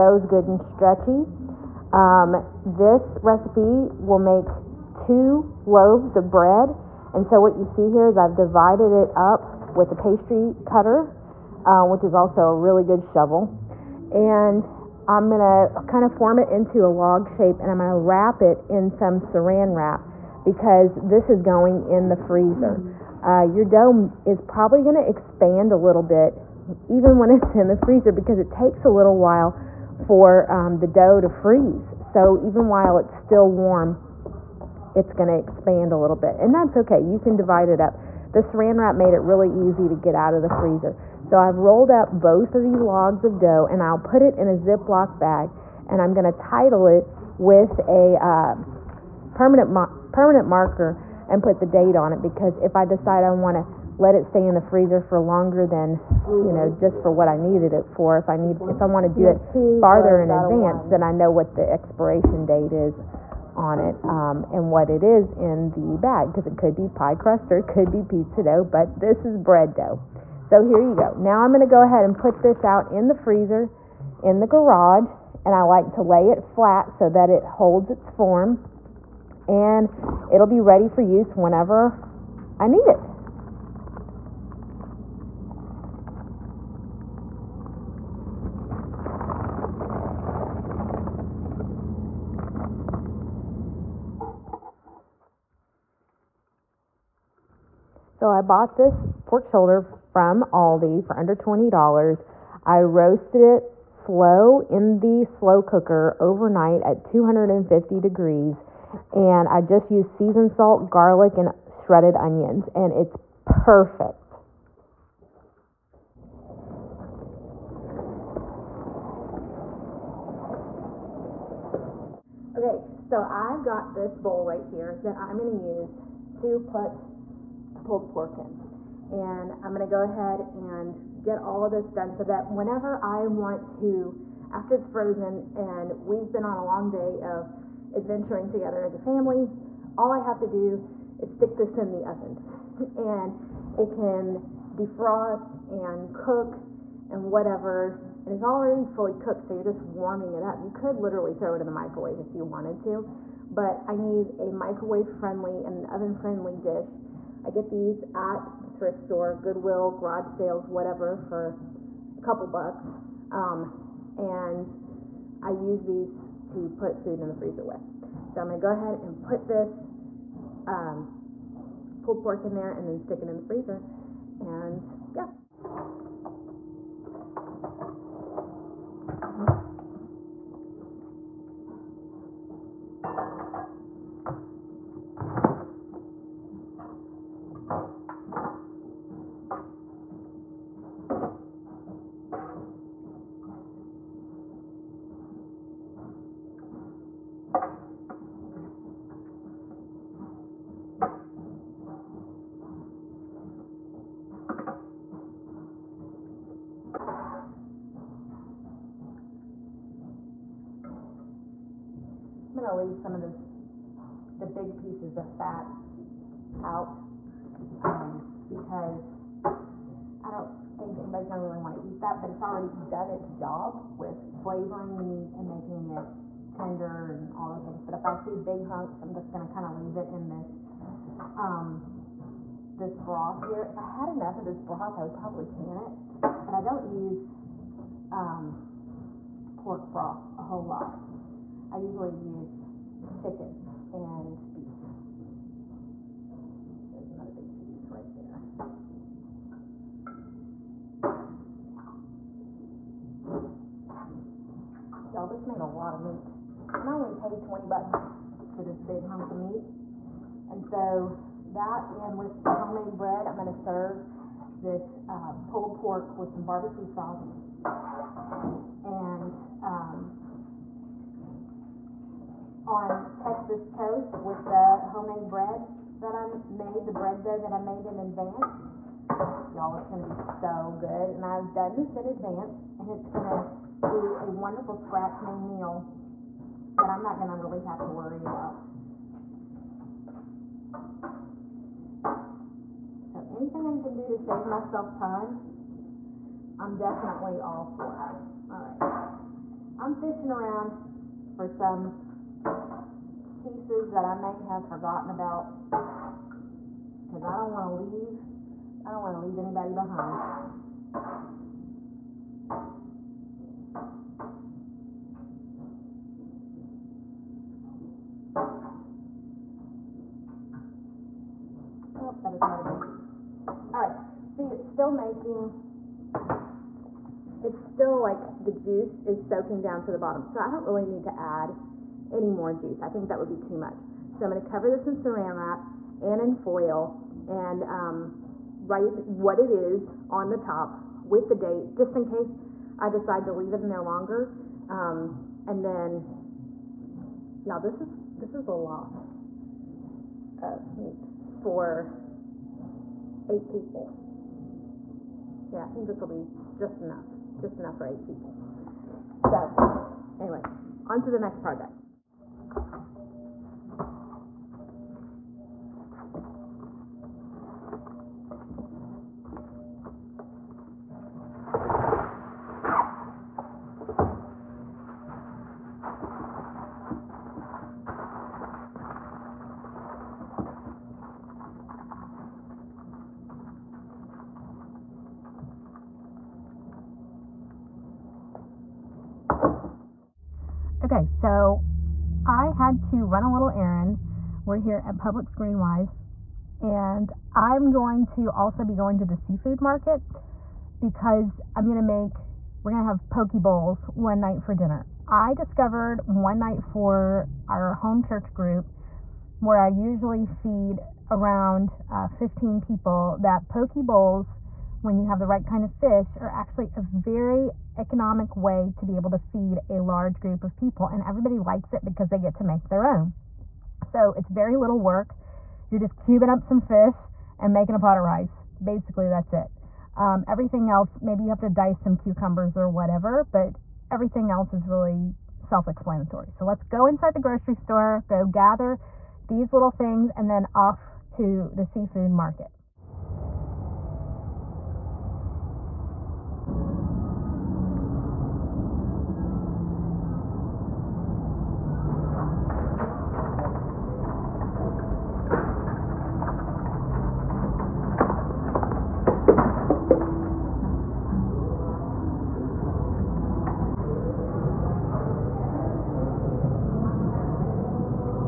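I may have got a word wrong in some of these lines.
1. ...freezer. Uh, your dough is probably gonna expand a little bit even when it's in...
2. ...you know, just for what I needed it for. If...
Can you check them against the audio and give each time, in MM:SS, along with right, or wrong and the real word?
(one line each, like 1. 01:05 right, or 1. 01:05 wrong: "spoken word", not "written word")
1. 00:22 right
2. 00:56 right.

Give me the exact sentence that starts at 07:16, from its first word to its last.
So let's go inside the grocery store, go gather these little things, and then off to the seafood market.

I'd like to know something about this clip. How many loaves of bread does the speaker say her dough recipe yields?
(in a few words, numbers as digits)
2.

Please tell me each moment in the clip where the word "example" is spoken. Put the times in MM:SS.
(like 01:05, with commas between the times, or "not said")
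not said.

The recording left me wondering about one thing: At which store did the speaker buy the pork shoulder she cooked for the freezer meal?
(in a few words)
Aldi.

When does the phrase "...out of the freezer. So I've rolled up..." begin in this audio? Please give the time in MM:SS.
00:40.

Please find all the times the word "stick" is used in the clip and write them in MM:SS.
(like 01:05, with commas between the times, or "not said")
02:21, 02:53.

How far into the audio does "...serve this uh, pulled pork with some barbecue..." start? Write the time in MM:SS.
04:23.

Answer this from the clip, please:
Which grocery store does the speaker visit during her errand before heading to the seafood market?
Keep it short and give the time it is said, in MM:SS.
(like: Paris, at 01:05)
Publix GreenWise, at 06:34.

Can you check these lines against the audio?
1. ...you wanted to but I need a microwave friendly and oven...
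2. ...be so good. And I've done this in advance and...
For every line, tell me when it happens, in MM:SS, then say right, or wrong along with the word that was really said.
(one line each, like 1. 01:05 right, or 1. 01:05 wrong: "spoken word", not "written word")
1. 02:32 right
2. 04:40 right.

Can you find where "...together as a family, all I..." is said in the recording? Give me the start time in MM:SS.
02:18.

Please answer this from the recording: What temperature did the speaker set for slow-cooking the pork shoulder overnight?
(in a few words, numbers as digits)
250 degrees.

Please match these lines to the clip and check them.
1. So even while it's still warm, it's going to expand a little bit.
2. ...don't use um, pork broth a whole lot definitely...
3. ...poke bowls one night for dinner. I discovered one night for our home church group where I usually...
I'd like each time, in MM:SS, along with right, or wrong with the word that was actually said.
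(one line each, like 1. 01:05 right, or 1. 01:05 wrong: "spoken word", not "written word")
1. 00:32 right
2. 03:56 wrong: "usually", not "definitely"
3. 06:43 right.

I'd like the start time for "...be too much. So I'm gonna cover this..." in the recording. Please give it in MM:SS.
05:33.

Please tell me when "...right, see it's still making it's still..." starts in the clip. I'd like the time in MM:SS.
05:23.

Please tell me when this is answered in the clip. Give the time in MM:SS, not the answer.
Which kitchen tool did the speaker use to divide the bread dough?
00:09.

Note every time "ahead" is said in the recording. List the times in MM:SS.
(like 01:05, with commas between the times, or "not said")
01:11, 02:10, 02:48.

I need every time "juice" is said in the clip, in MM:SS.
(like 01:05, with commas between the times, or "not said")
05:28, 05:32.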